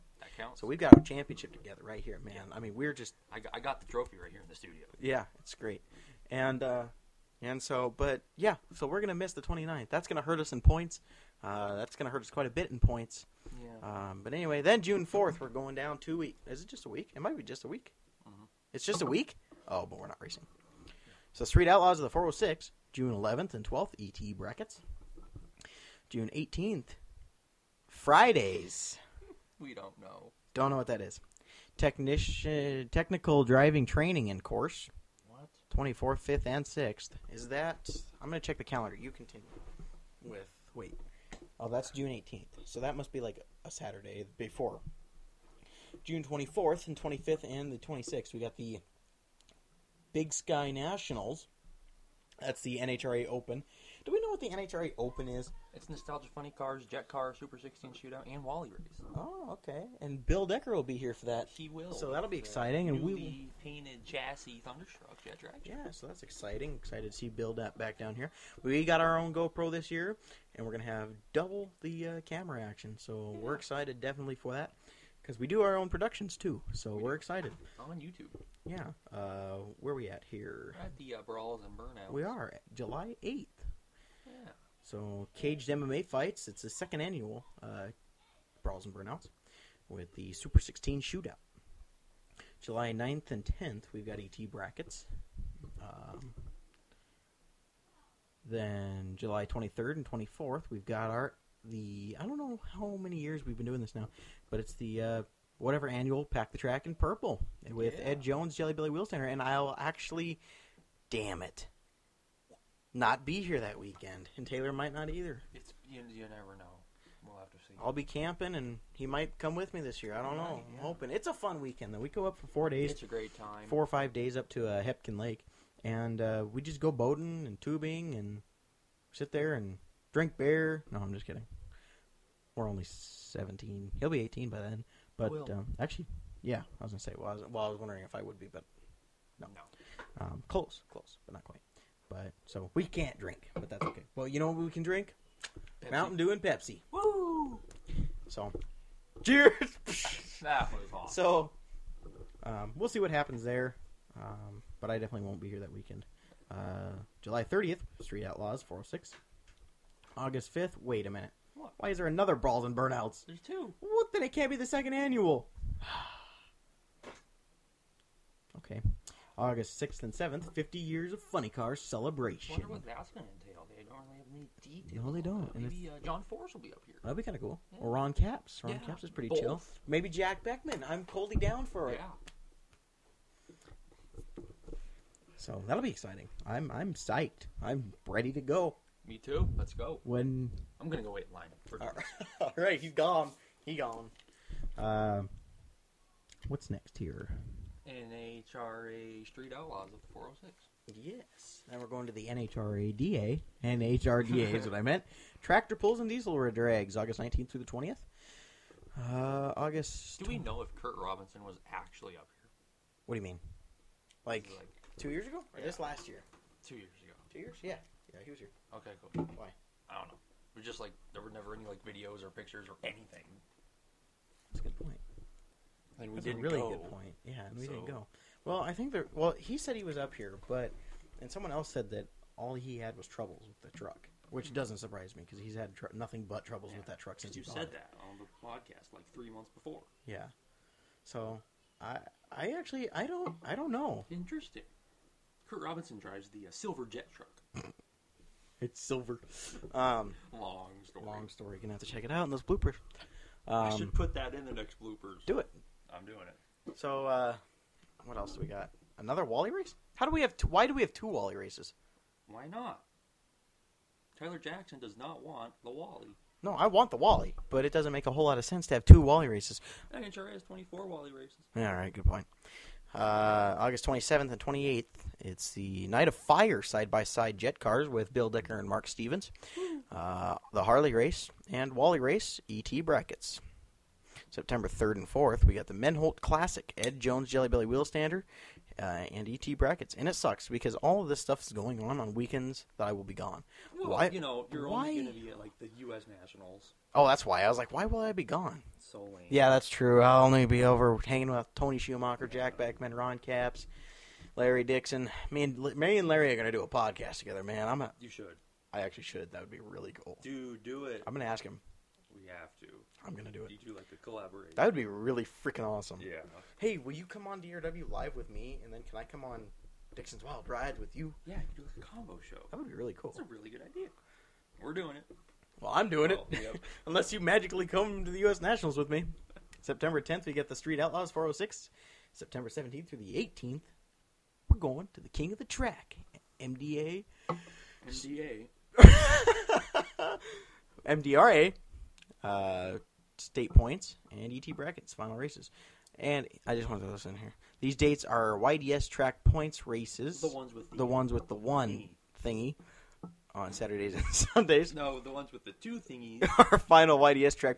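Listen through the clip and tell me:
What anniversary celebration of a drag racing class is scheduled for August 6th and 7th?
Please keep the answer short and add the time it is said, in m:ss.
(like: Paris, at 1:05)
50 years of Funny Car, at 2:50.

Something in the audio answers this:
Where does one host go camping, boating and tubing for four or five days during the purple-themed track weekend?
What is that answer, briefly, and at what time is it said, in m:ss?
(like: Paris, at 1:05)
Hebgen Lake, at 2:04.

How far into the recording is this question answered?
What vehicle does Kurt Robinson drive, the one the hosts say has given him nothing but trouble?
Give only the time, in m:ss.
4:06.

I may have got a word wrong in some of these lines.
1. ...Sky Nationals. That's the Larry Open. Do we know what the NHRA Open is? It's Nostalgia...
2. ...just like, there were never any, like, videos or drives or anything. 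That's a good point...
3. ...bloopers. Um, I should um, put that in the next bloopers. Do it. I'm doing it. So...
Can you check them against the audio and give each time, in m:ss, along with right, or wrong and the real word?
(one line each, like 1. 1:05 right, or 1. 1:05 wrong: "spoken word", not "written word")
1. 0:50 wrong: "NHRA", not "Larry"
2. 3:40 wrong: "pictures", not "drives"
3. 4:12 right.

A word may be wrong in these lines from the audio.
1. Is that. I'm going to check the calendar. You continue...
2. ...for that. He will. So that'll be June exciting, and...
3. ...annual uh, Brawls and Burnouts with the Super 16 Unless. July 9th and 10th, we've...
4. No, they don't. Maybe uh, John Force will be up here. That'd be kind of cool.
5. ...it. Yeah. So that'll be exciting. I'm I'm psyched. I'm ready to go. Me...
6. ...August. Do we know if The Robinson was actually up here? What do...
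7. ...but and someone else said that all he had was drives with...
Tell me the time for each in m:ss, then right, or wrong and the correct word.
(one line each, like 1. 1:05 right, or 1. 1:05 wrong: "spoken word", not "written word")
1. 0:37 right
2. 1:01 wrong: "The", not "June"
3. 1:27 wrong: "Shootout", not "Unless"
4. 2:55 right
5. 3:01 right
6. 3:29 wrong: "Kurt", not "The"
7. 3:50 wrong: "troubles", not "drives".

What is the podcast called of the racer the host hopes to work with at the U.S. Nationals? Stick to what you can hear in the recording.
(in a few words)
Dixon's Wild Ride.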